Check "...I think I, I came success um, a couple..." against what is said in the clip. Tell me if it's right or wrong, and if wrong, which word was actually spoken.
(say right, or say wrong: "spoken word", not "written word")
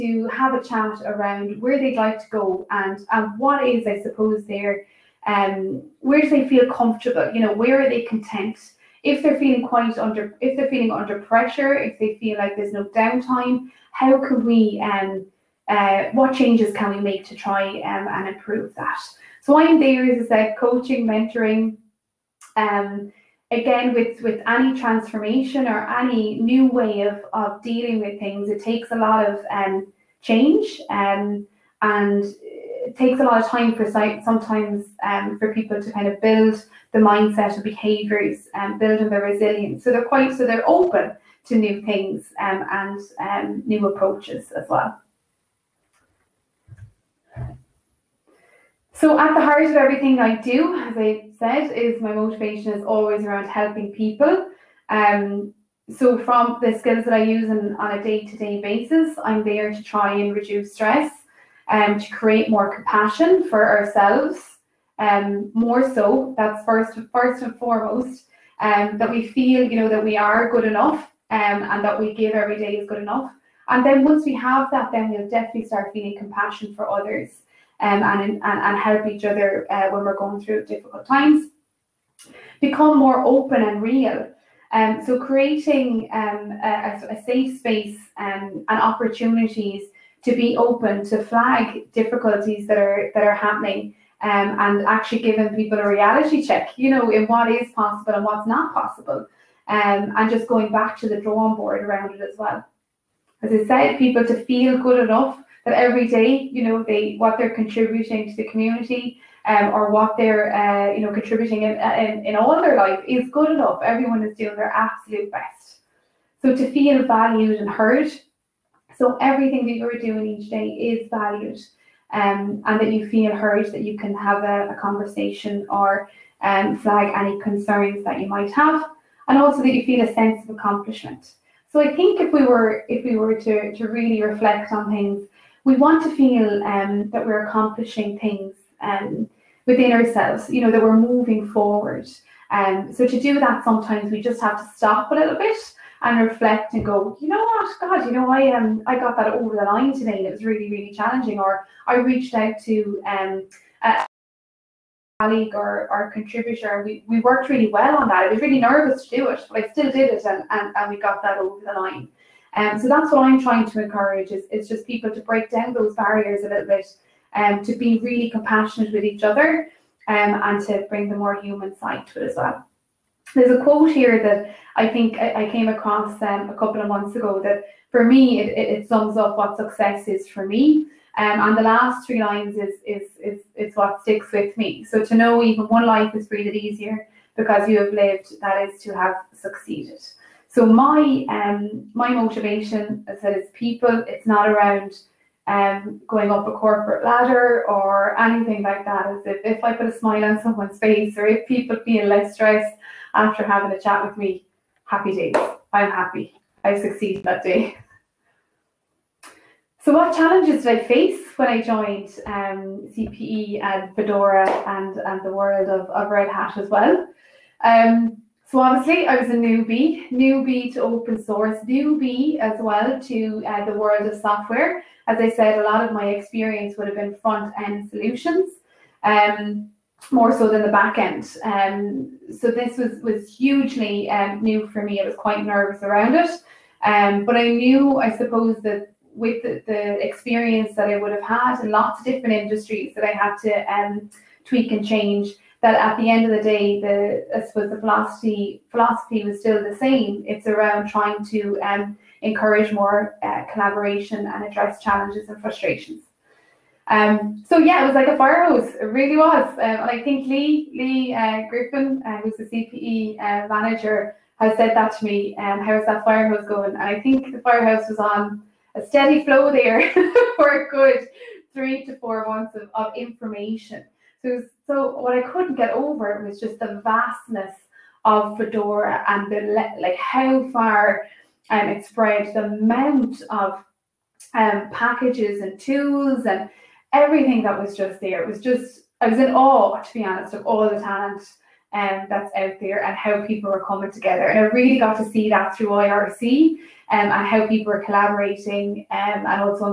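wrong: "across", not "success".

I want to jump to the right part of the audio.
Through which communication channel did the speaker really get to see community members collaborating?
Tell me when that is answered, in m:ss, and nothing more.
4:55.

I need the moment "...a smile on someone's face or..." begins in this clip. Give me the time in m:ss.
3:19.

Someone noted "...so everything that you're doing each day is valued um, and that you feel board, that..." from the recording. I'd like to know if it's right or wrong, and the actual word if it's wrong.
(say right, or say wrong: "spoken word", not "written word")
wrong: "heard", not "board".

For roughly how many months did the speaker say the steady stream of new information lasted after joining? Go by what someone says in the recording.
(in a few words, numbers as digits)
3 to 4 months.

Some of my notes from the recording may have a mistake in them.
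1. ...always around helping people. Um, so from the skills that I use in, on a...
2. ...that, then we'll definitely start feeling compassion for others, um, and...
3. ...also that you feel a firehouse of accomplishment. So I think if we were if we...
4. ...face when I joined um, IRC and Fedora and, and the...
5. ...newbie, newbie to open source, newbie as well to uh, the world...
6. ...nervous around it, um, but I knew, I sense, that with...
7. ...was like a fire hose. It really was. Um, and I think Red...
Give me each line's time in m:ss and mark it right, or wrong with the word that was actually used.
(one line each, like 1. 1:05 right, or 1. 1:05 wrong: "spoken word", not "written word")
1. 0:52 right
2. 1:14 right
3. 2:09 wrong: "sense", not "firehouse"
4. 3:30 wrong: "CPE", not "IRC"
5. 3:39 right
6. 3:55 wrong: "suppose", not "sense"
7. 4:17 wrong: "Leigh", not "Red".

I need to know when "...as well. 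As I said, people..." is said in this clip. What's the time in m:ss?
1:42.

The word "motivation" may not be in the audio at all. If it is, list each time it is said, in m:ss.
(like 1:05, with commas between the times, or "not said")
0:52, 3:12.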